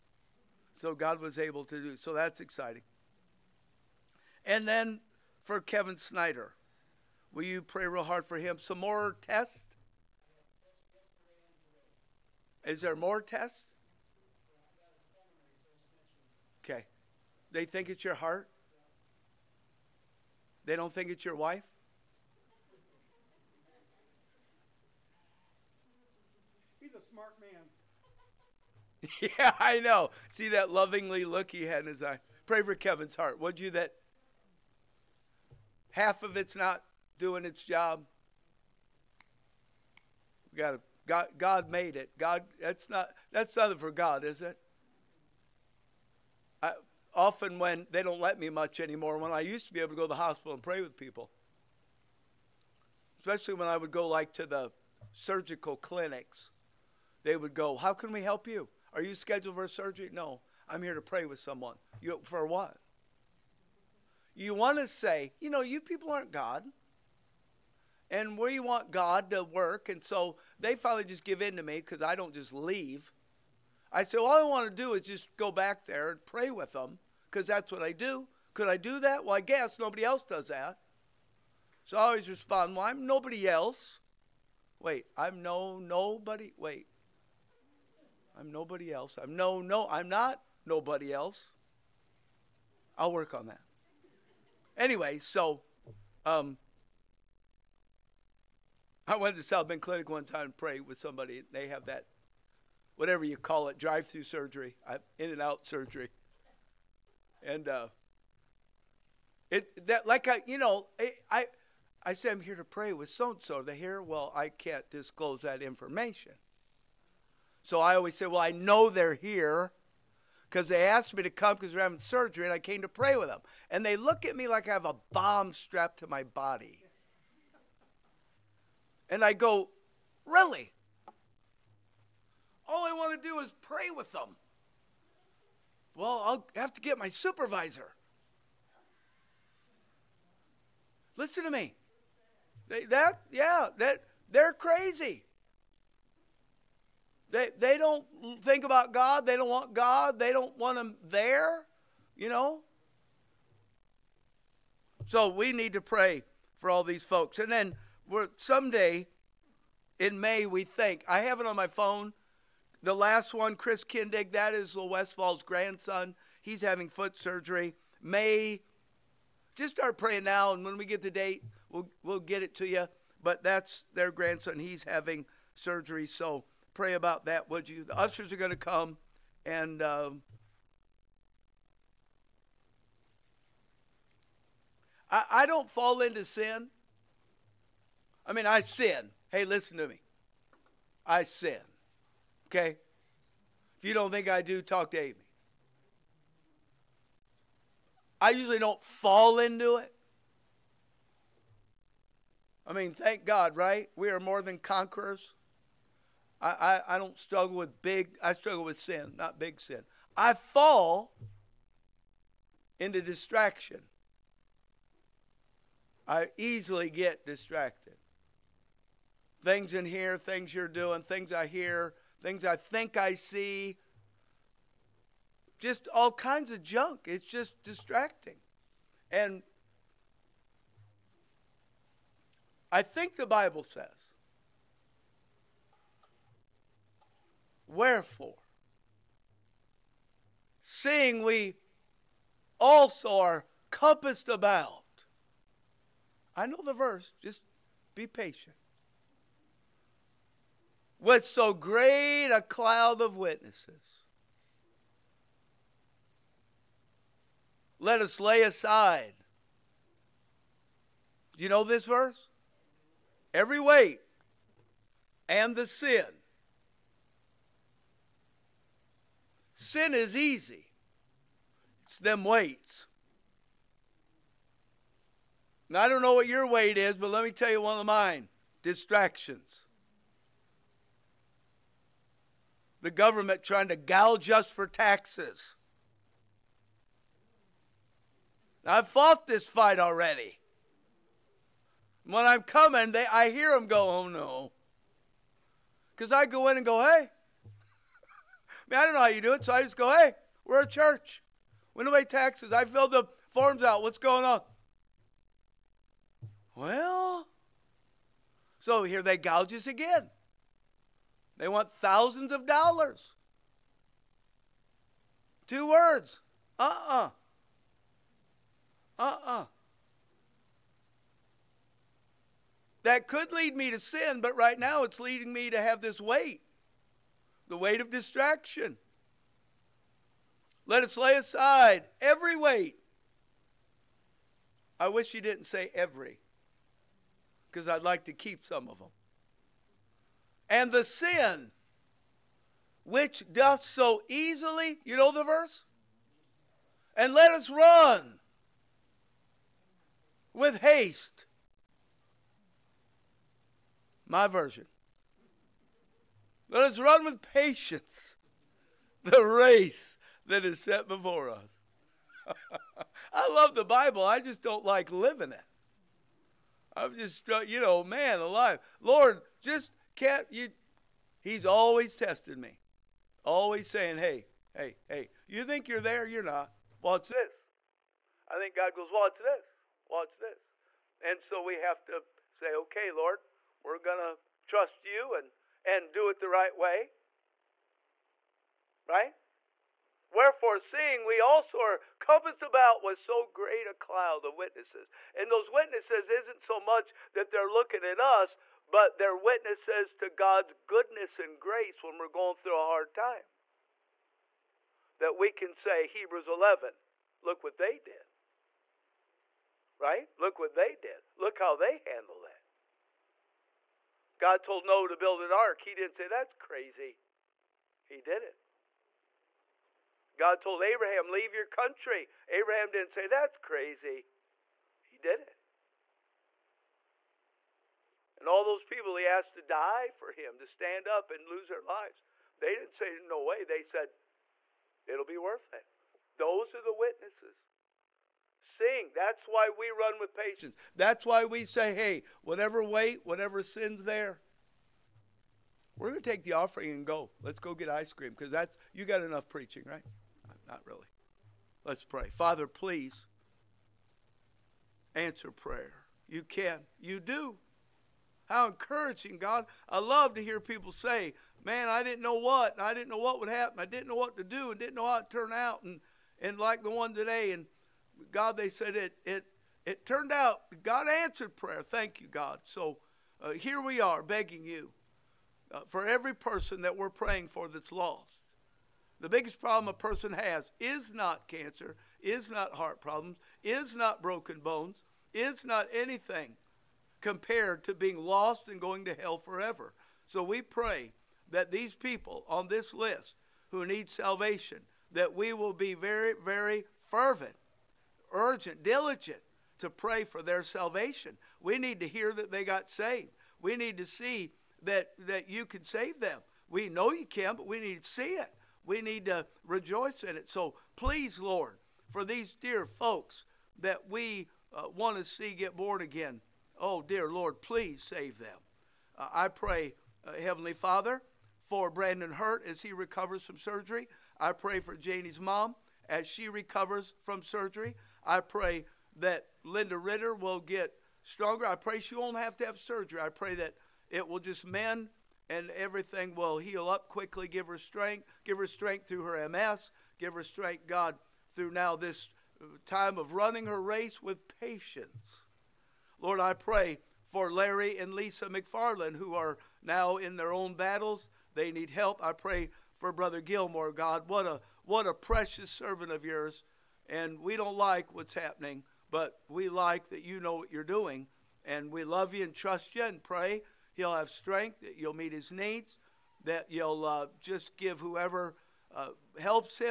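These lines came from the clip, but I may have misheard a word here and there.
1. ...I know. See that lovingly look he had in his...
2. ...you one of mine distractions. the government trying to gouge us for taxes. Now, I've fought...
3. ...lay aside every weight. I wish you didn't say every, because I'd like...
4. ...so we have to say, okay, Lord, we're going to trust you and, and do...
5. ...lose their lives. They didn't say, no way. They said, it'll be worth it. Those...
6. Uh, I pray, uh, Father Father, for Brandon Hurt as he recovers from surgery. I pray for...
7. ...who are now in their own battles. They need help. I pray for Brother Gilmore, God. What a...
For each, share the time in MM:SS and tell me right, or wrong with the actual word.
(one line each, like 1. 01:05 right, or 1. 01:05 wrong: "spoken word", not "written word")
1. 00:29 right
2. 04:37 right
3. 05:30 right
4. 06:21 right
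5. 07:11 right
6. 08:38 wrong: "Heavenly", not "Father"
7. 09:08 right.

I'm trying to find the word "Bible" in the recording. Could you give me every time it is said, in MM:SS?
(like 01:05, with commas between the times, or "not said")
03:53, 06:03.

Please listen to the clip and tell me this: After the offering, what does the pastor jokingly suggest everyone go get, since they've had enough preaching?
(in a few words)
ice cream.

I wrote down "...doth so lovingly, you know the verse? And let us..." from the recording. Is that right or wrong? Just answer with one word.
wrong.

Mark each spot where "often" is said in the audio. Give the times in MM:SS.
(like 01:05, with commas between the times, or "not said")
00:47.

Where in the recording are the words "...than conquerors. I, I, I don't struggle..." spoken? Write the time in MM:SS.
03:24.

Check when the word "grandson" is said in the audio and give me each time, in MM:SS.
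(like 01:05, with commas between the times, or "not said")
02:45, 02:54.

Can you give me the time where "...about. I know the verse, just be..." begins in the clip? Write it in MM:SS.
04:04.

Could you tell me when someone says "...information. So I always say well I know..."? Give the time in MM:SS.
01:55.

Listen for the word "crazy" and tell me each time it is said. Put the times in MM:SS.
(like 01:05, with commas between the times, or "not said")
02:24, 06:56, 07:03.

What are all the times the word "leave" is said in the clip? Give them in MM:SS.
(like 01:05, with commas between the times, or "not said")
01:12, 07:01.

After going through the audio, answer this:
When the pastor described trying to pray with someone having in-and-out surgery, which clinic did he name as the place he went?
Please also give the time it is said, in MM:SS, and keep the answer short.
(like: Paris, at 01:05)
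South Bend Clinic, at 01:39.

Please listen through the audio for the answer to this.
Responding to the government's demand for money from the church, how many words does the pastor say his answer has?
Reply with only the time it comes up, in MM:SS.
05:15.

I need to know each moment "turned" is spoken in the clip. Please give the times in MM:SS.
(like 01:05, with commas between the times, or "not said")
07:45, 07:49.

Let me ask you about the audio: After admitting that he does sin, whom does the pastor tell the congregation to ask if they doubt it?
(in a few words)
Amy.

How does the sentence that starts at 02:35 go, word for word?
So we need to pray for all these folks.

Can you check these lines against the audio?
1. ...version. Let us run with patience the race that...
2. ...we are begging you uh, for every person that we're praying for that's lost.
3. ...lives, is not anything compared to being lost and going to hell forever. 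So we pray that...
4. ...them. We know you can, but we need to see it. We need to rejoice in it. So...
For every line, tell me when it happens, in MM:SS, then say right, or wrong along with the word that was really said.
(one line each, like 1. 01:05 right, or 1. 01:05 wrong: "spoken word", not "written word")
1. 05:54 right
2. 07:53 right
3. 08:04 wrong: "bones", not "lives"
4. 08:25 right.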